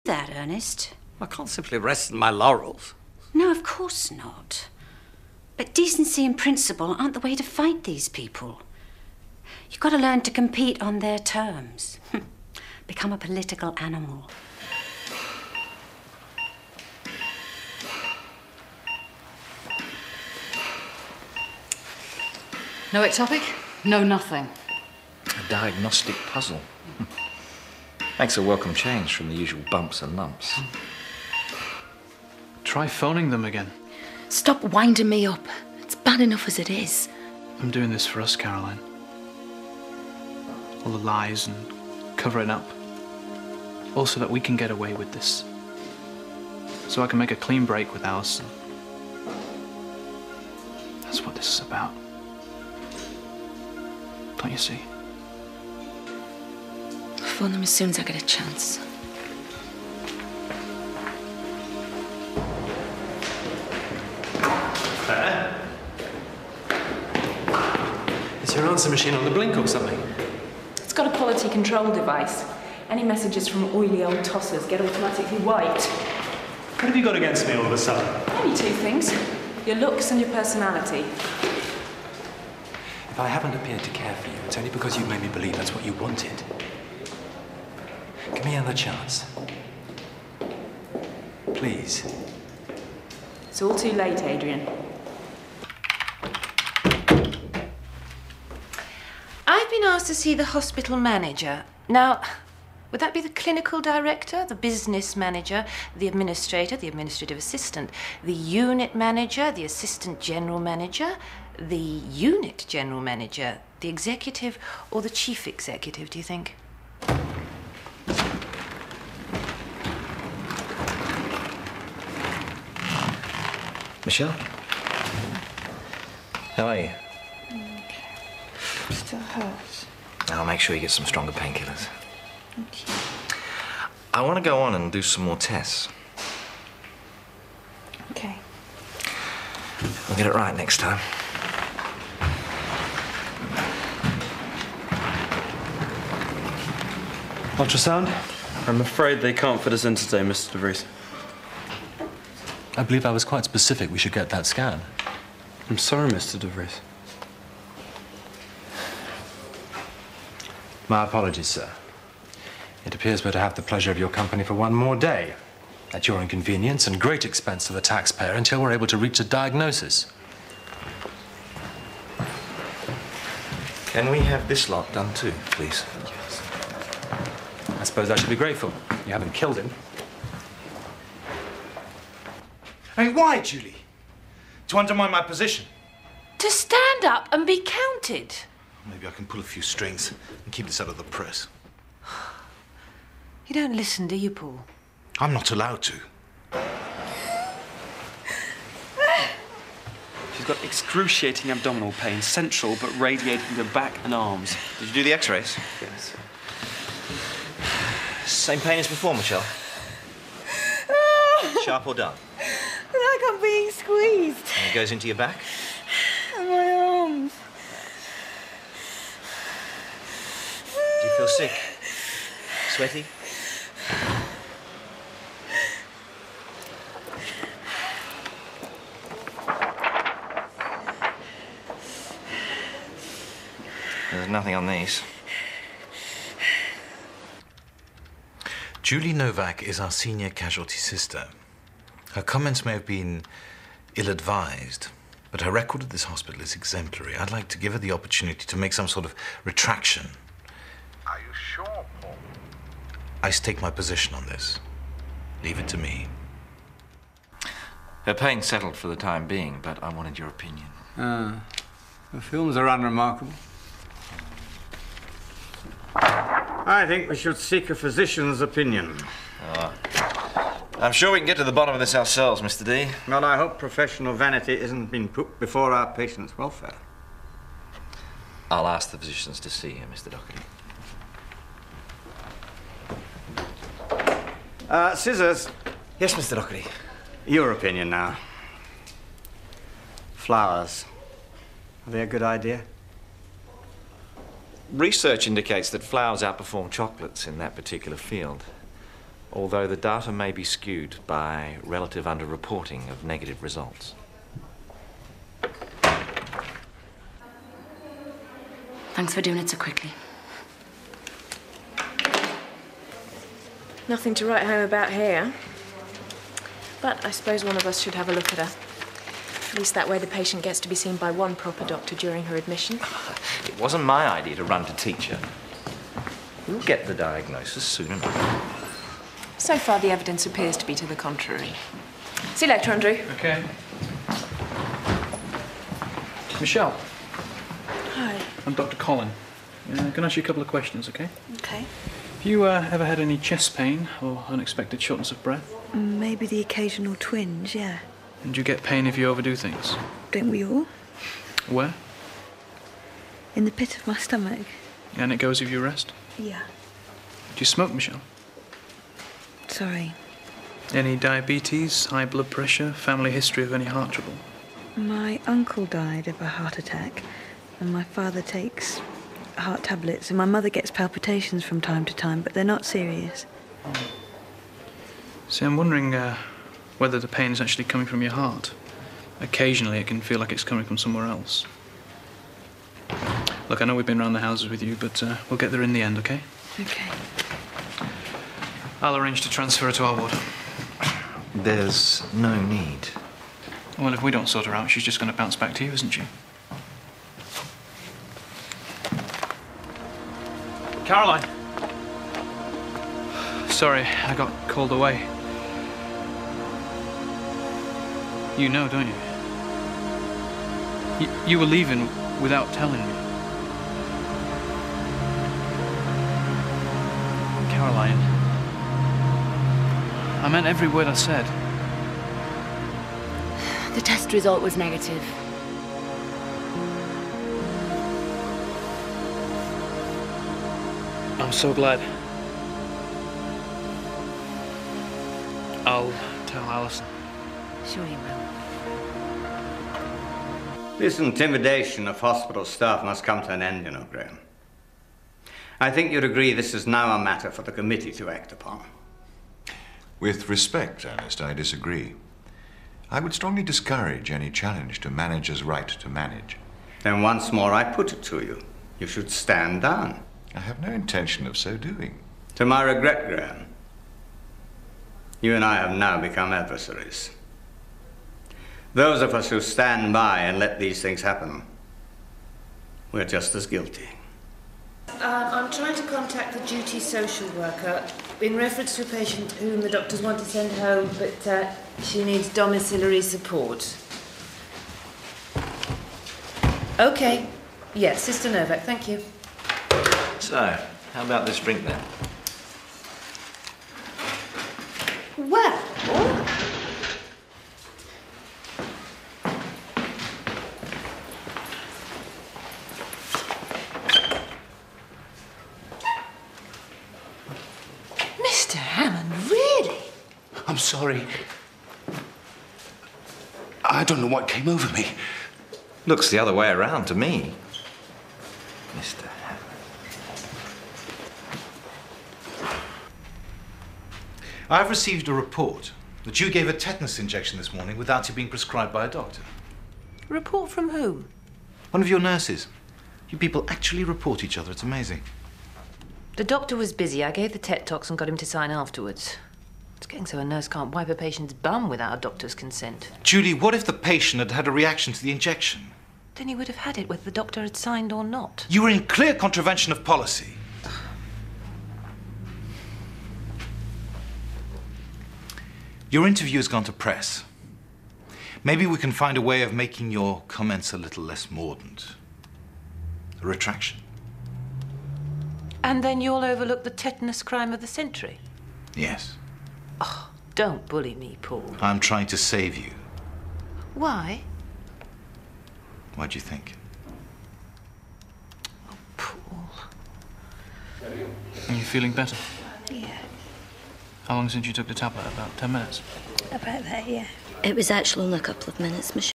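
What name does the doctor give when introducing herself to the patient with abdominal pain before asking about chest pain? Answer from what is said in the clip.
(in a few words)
Dr. Collin.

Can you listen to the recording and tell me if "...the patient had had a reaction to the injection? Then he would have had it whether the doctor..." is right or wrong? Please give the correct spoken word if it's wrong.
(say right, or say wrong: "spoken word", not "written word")
right.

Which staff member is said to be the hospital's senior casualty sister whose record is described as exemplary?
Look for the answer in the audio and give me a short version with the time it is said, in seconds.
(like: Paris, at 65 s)
Julie Novak, at 238 s.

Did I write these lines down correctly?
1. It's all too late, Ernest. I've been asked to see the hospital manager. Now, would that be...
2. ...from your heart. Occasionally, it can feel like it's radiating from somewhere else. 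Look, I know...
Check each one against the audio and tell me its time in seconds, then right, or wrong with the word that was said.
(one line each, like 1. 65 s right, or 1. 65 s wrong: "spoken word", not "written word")
1. 93 s wrong: "Adrian", not "Ernest"
2. 377 s wrong: "coming", not "radiating".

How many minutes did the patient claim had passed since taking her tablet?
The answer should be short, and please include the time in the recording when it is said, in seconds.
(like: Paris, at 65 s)
10, at 585 s.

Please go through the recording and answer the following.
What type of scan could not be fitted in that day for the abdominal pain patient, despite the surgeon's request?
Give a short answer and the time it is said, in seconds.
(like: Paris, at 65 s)
Ultrasound, at 147 s.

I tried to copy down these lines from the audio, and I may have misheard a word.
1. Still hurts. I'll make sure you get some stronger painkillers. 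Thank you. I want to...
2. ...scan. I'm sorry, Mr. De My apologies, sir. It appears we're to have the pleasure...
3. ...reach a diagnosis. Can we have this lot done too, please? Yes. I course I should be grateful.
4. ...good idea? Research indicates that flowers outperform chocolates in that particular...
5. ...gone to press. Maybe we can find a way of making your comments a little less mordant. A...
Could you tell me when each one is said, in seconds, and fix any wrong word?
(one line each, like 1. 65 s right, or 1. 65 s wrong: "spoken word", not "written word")
1. 128 s right
2. 154 s right
3. 168 s wrong: "suppose", not "course"
4. 292 s right
5. 556 s right.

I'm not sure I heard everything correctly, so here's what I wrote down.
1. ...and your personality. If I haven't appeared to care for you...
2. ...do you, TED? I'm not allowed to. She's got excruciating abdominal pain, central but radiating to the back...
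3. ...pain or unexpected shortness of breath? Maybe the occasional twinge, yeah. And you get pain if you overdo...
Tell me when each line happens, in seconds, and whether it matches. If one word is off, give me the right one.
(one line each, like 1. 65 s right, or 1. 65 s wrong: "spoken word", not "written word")
1. 80 s right
2. 194 s wrong: "Paul", not "TED"
3. 343 s right.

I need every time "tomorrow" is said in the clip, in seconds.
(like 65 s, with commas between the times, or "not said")
not said.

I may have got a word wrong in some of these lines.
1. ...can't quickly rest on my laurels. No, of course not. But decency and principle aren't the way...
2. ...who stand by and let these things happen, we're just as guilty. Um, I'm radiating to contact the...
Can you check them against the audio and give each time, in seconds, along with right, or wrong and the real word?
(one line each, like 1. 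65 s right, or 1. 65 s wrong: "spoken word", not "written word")
1. 1 s wrong: "simply", not "quickly"
2. 469 s wrong: "trying", not "radiating".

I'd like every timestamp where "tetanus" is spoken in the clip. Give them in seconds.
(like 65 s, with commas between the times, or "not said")
526 s, 566 s.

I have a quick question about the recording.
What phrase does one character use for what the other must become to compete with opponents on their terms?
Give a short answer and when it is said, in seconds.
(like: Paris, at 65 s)
Political animal, at 13 s.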